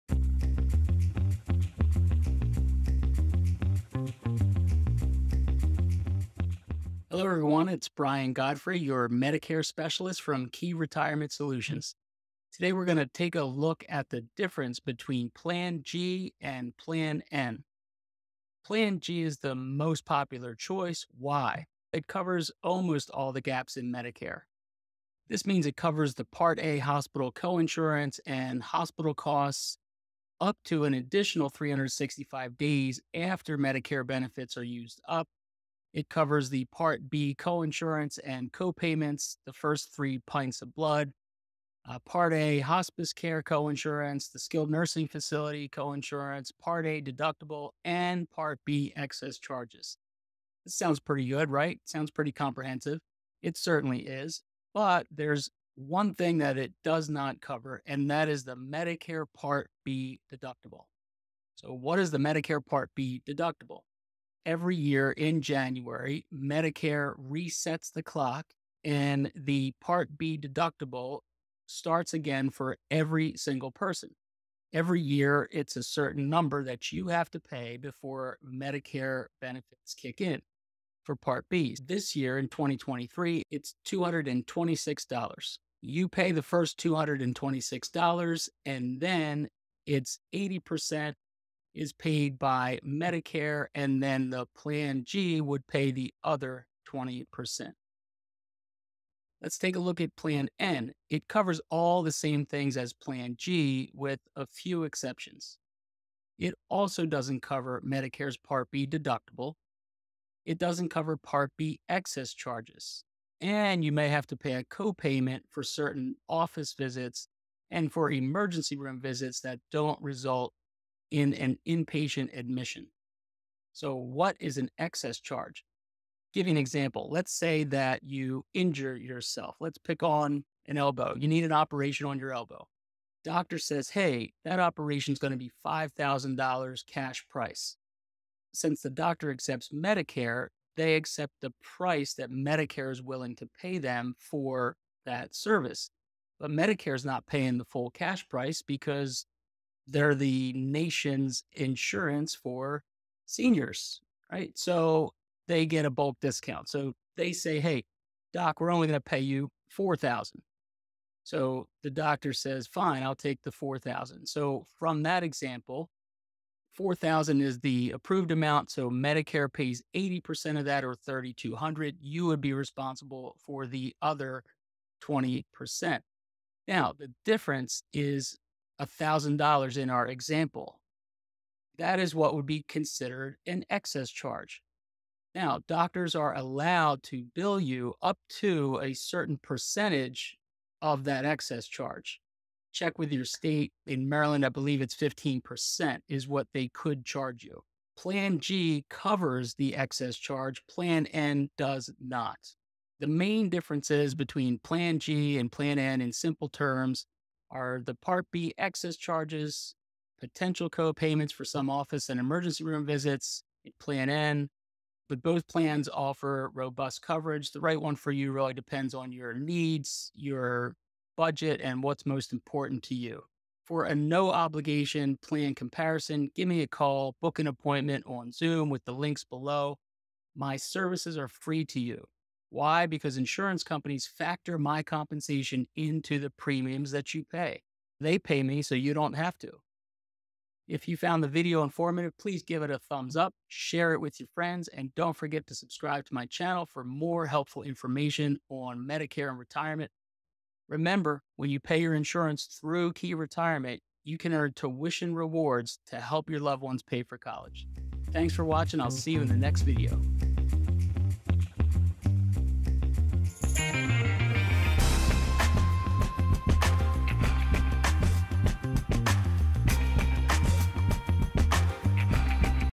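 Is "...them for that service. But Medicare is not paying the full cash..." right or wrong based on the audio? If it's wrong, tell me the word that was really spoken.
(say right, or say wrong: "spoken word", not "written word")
right.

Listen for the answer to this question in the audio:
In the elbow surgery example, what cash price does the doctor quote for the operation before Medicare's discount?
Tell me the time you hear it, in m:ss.
2:15.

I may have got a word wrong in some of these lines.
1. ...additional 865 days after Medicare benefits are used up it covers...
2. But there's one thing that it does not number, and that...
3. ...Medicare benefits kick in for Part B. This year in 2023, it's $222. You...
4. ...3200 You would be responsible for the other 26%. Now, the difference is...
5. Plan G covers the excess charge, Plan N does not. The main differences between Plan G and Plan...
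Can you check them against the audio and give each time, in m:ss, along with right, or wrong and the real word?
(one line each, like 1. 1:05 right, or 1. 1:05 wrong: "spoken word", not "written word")
1. 0:30 wrong: "365", not "865"
2. 0:54 wrong: "cover", not "number"
3. 1:18 wrong: "226", not "222"
4. 2:50 wrong: "20", not "26"
5. 3:17 right.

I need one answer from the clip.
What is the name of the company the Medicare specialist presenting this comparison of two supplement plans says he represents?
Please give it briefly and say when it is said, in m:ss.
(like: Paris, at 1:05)
Key Retirement Solutions, at 0:10.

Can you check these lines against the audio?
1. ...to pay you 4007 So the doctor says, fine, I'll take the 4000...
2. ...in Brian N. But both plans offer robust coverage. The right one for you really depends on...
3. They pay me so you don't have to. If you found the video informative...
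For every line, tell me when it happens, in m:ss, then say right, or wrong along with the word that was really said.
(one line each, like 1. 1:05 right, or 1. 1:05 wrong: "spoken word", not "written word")
1. 2:38 wrong: "4000", not "4007"
2. 3:33 wrong: "Plan", not "Brian"
3. 3:58 right.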